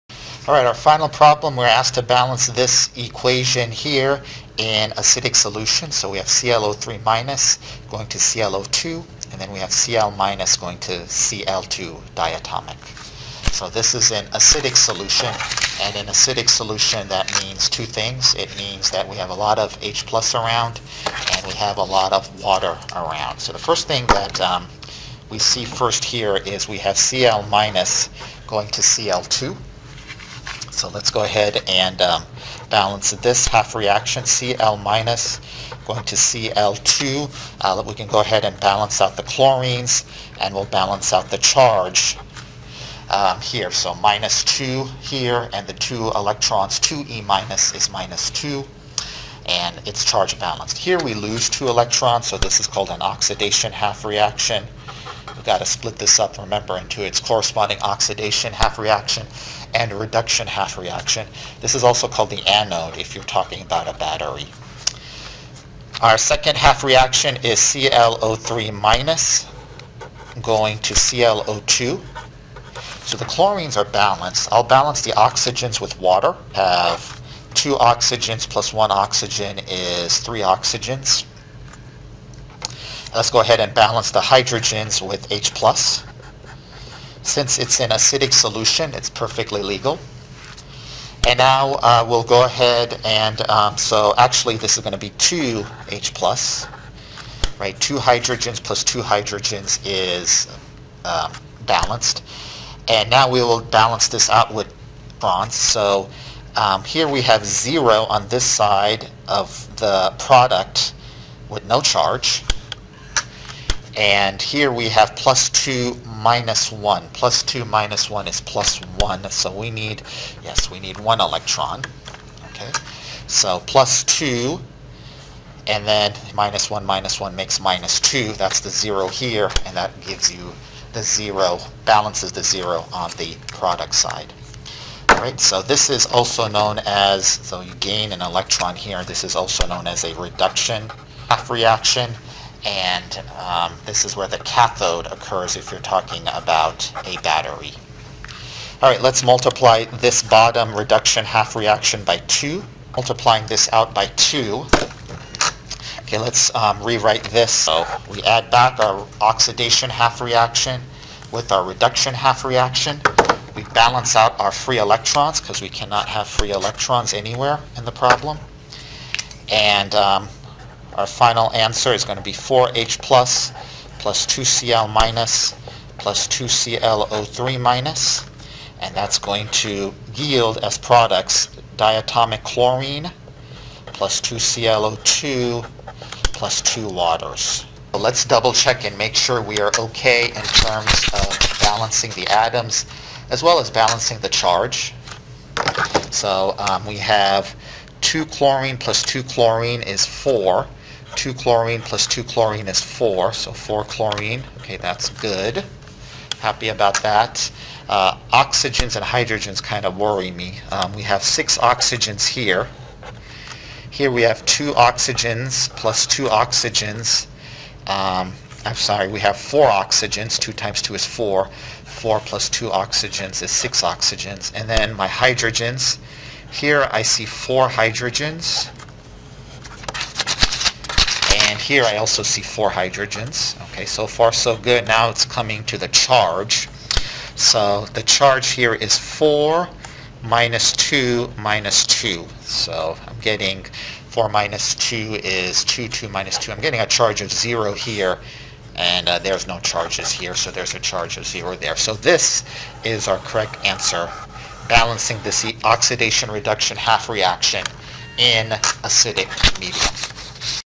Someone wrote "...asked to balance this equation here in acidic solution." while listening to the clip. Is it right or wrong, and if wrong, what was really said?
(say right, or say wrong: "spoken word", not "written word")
right.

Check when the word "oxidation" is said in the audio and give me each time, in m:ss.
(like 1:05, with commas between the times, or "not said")
0:53, 0:57, 2:39, 4:15.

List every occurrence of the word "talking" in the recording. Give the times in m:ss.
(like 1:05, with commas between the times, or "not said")
1:03, 2:25.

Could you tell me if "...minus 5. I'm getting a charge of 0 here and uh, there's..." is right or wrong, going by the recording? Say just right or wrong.
wrong.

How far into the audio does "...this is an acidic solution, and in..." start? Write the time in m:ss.
0:13.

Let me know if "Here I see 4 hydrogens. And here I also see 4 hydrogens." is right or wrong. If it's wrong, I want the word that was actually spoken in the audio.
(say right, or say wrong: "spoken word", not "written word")
right.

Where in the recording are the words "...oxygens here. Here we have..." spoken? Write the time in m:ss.
3:31.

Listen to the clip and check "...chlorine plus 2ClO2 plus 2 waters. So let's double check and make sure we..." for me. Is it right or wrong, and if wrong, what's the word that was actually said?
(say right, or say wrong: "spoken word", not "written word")
right.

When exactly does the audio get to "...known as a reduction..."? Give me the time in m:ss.
2:19.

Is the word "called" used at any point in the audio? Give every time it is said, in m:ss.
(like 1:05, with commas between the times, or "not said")
0:52, 1:02.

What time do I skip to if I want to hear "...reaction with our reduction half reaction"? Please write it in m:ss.
2:40.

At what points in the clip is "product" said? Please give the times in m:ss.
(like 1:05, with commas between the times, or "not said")
1:50, 2:13, 3:00.